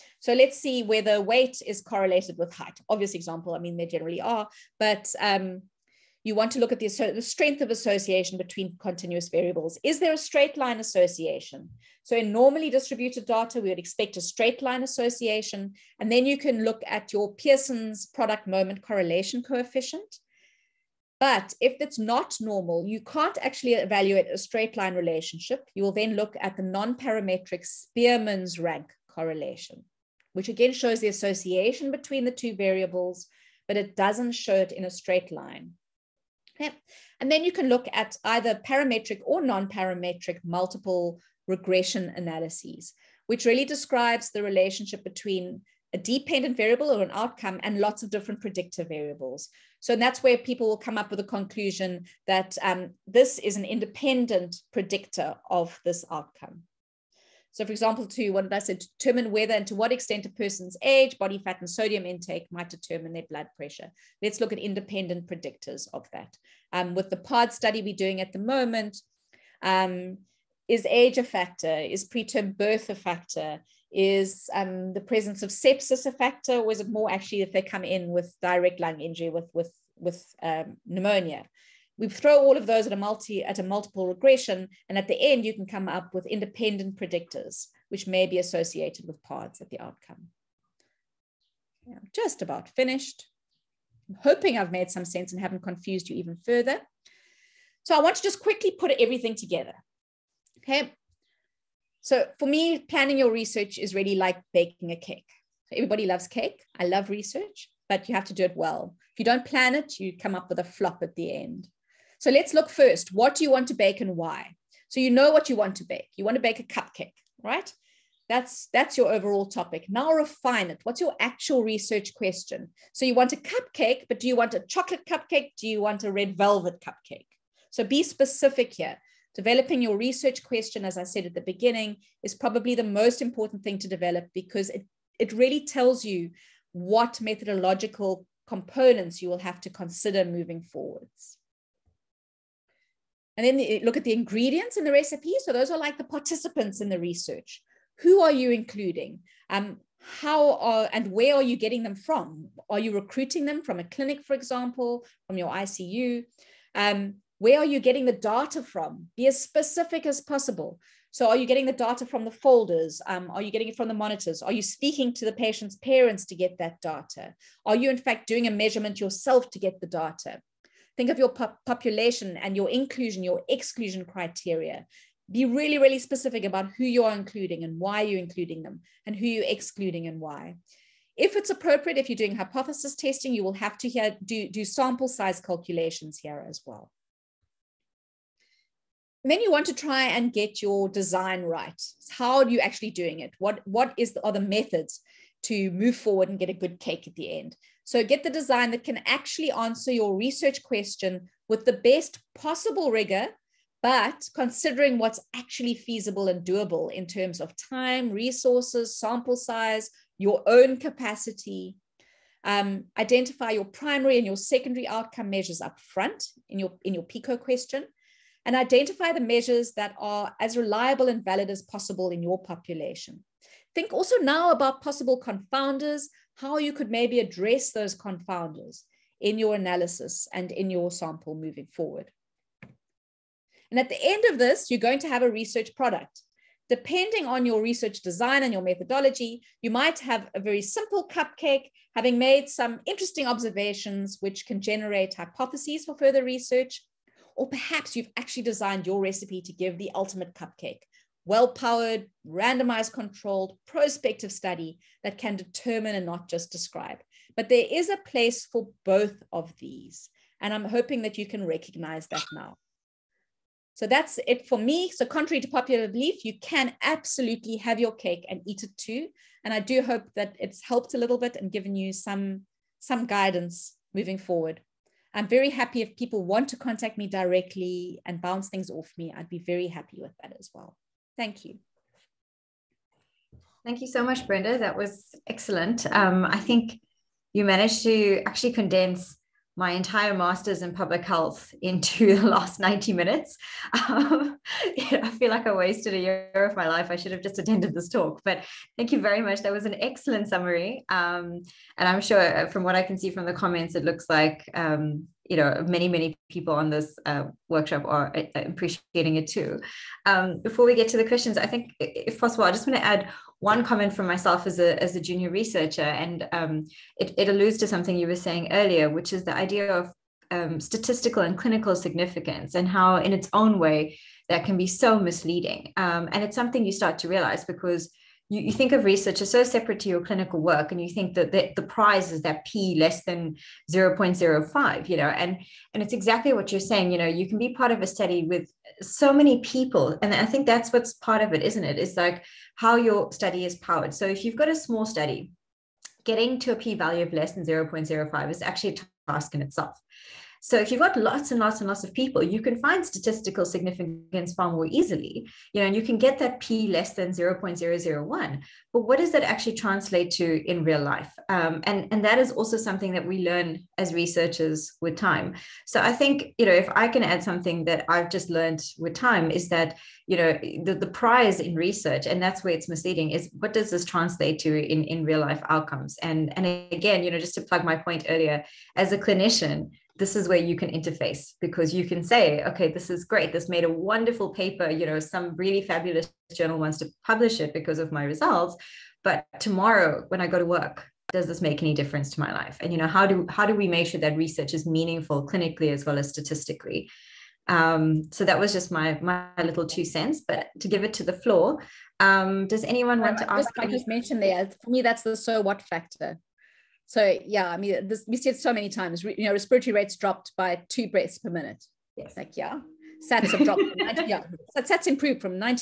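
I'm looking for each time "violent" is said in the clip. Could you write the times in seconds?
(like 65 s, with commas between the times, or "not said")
not said.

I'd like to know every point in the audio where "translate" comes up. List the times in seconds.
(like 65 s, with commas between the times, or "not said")
359 s, 373 s.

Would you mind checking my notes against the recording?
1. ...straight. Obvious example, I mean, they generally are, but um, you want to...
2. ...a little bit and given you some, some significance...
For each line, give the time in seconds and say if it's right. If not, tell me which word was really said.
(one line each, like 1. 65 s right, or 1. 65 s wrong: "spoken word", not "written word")
1. 2 s wrong: "height", not "straight"
2. 270 s wrong: "guidance", not "significance".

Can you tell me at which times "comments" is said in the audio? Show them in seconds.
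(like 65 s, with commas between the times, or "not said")
303 s, 313 s.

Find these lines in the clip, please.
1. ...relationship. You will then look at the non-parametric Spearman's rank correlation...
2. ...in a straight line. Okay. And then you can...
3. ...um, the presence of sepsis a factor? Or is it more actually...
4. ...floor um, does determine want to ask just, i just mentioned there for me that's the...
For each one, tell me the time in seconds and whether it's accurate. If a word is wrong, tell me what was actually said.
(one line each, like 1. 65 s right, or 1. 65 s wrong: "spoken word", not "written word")
1. 24 s right
2. 34 s right
3. 74 s right
4. 401 s wrong: "anyone", not "determine".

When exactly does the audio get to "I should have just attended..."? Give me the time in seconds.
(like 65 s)
296 s.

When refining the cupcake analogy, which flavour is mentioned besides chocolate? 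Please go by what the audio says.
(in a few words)
Red velvet.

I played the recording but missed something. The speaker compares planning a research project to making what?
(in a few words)
Baking a cake.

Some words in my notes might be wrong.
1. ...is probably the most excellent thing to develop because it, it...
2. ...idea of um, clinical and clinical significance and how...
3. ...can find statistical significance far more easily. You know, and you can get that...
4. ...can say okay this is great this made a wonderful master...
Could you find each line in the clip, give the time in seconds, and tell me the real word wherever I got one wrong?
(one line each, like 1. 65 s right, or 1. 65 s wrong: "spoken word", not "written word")
1. 132 s wrong: "important", not "excellent"
2. 319 s wrong: "statistical", not "clinical"
3. 352 s right
4. 381 s wrong: "paper", not "master".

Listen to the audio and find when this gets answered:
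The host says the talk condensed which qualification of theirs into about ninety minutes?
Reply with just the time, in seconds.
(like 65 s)
290 s.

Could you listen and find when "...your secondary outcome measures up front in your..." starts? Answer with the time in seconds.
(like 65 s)
214 s.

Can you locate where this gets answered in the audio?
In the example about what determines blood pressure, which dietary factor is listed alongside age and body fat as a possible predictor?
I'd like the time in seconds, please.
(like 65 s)
61 s.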